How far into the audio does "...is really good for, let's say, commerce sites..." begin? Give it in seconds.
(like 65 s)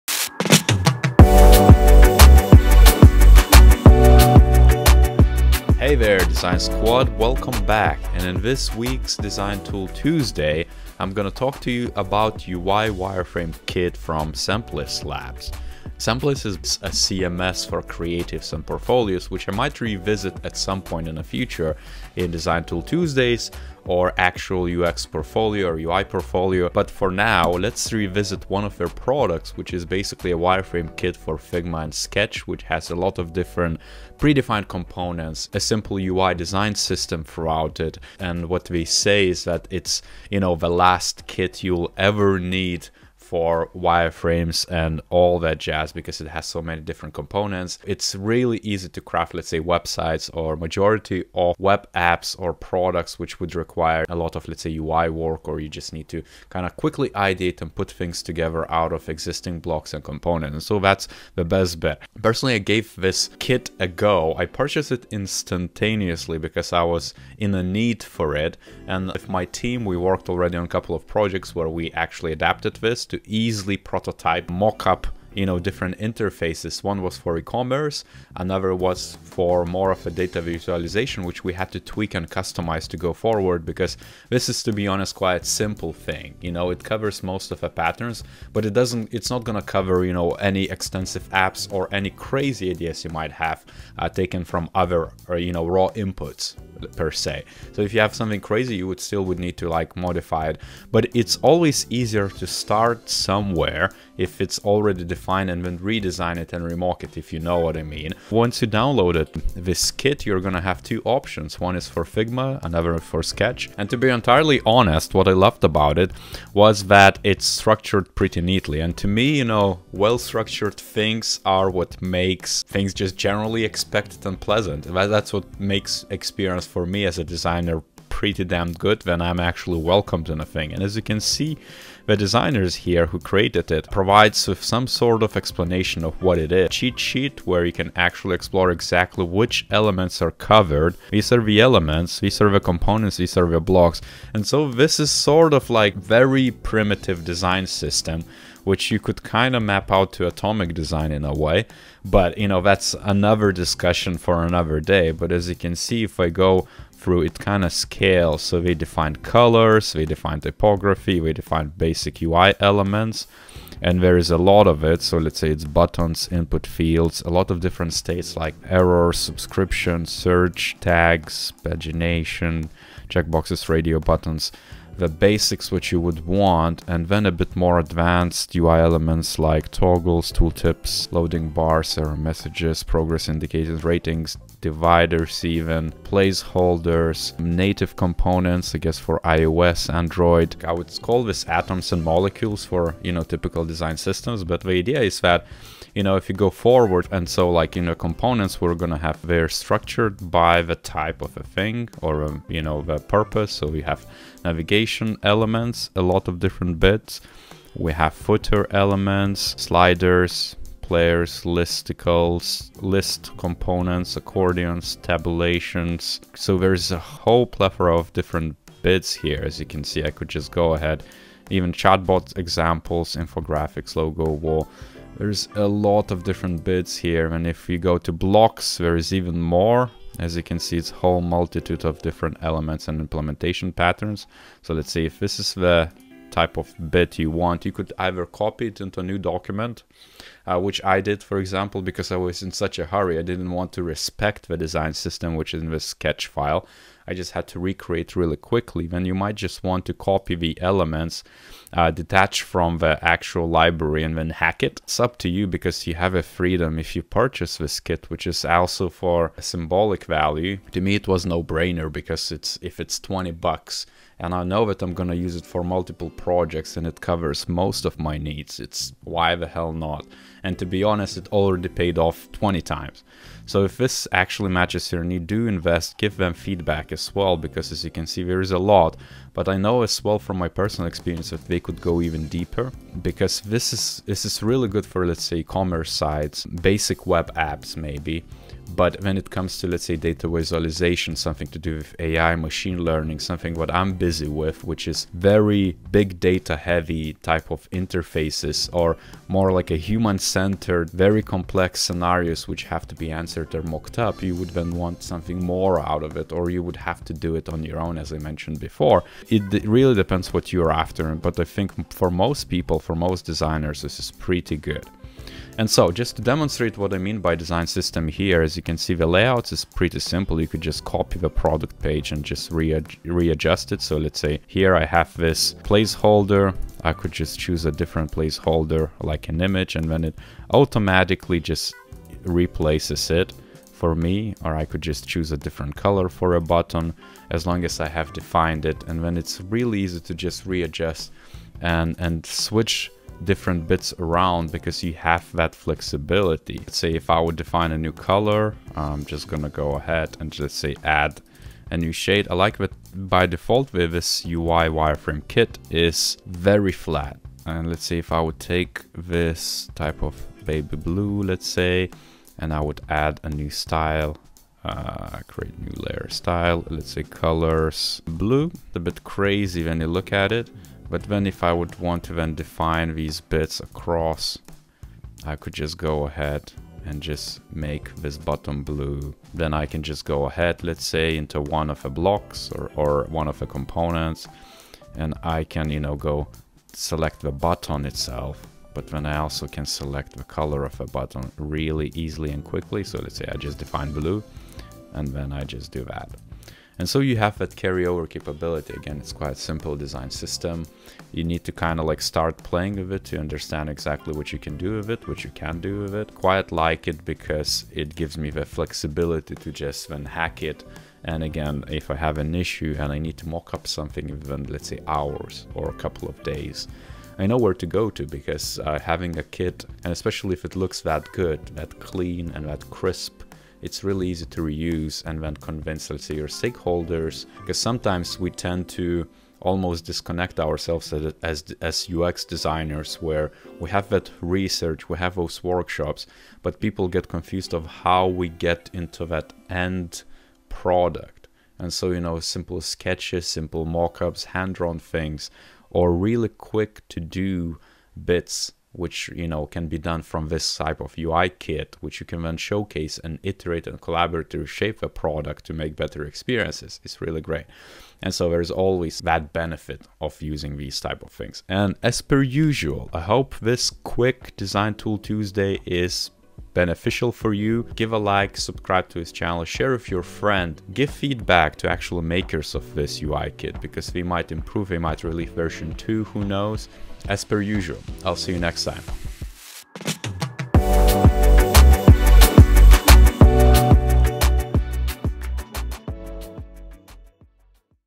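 284 s.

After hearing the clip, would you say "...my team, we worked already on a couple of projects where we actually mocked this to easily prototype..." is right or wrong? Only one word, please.
wrong.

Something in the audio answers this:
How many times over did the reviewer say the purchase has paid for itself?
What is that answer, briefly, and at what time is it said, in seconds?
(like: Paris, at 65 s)
20, at 272 s.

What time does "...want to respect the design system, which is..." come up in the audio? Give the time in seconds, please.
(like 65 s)
243 s.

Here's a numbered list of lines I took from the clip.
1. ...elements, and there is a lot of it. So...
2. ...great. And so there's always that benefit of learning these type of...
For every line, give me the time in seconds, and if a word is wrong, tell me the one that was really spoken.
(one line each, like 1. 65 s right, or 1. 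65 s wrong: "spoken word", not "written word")
1. 162 s right
2. 457 s wrong: "using", not "learning".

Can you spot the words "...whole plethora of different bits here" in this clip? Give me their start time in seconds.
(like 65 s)
216 s.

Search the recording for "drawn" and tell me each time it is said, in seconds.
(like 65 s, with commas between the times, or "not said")
444 s.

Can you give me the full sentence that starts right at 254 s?
It's up to you because you have a freedom if you purchase this kit, which is also for a symbolic value.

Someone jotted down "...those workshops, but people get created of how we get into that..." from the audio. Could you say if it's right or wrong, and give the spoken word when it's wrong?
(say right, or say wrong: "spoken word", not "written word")
wrong: "confused", not "created".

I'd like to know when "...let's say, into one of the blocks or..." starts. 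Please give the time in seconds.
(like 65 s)
380 s.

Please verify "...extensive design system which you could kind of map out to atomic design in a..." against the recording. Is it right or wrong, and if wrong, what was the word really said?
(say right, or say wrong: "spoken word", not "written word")
wrong: "primitive", not "extensive".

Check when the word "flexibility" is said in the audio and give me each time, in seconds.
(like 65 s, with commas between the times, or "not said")
345 s, 408 s.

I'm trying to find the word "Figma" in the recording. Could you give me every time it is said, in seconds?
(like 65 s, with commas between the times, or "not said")
31 s, 112 s.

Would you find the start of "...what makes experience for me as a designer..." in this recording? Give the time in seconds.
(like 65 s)
125 s.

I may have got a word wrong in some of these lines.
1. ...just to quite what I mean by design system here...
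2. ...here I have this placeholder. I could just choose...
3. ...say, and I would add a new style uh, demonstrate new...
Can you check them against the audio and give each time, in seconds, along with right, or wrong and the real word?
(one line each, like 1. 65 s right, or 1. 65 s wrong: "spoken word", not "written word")
1. 315 s wrong: "demonstrate", not "quite"
2. 324 s right
3. 361 s wrong: "create", not "demonstrate".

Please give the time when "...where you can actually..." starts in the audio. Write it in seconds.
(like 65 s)
137 s.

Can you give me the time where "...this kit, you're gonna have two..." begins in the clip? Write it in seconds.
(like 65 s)
109 s.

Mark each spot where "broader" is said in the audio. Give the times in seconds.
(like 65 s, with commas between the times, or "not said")
not said.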